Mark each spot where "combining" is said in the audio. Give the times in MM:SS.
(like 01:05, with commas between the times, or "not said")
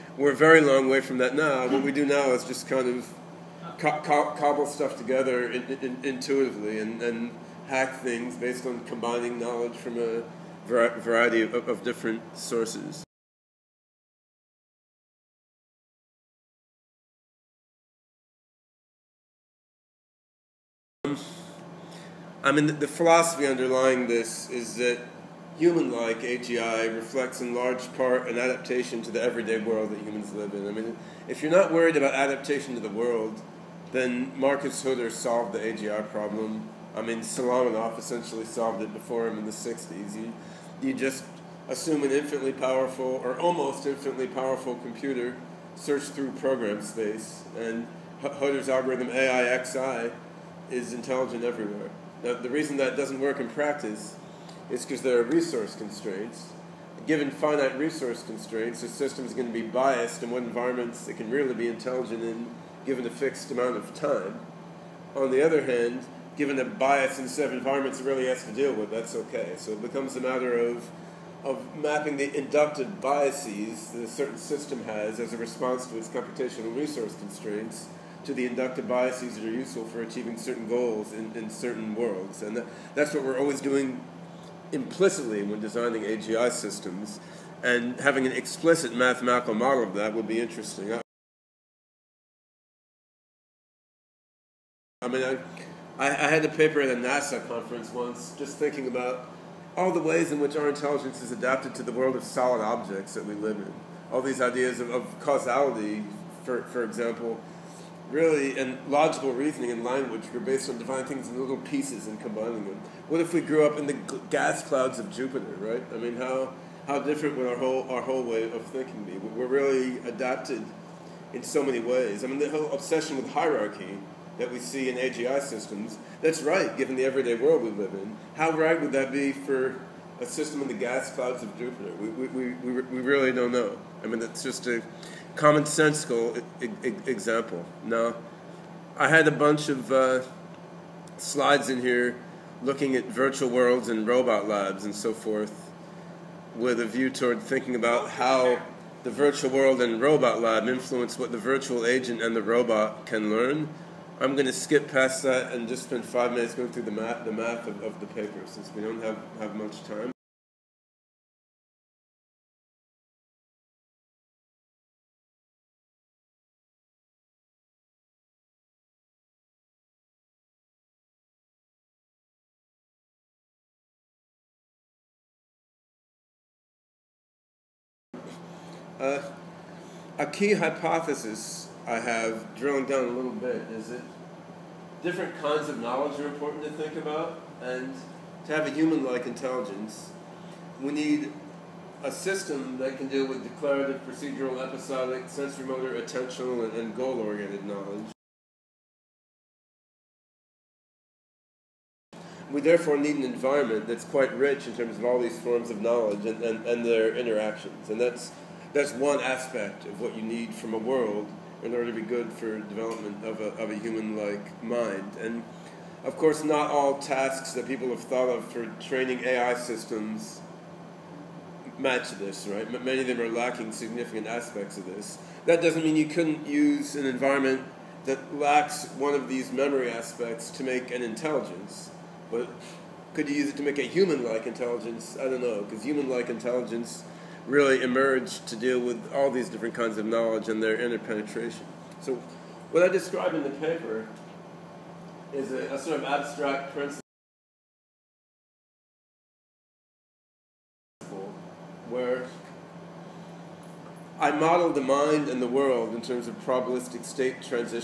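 00:08, 01:52.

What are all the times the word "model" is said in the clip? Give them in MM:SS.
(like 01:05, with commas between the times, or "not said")
01:29, 04:14.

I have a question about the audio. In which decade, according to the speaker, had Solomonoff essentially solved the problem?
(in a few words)
the 60s.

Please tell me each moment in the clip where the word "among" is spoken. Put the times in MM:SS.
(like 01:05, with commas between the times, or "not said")
not said.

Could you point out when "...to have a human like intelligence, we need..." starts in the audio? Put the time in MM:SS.
03:08.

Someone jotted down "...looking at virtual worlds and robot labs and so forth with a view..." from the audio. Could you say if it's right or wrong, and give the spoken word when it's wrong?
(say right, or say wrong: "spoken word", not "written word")
right.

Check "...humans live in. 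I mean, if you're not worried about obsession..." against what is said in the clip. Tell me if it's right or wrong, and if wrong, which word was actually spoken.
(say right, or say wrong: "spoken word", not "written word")
wrong: "adaptation", not "obsession".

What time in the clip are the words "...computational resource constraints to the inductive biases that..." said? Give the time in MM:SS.
01:16.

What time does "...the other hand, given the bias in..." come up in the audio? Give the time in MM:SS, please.
01:05.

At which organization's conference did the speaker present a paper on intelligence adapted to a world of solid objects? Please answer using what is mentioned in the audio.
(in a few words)
NASA.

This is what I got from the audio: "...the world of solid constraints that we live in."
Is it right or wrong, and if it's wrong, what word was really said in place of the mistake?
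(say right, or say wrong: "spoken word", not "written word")
wrong: "objects", not "constraints".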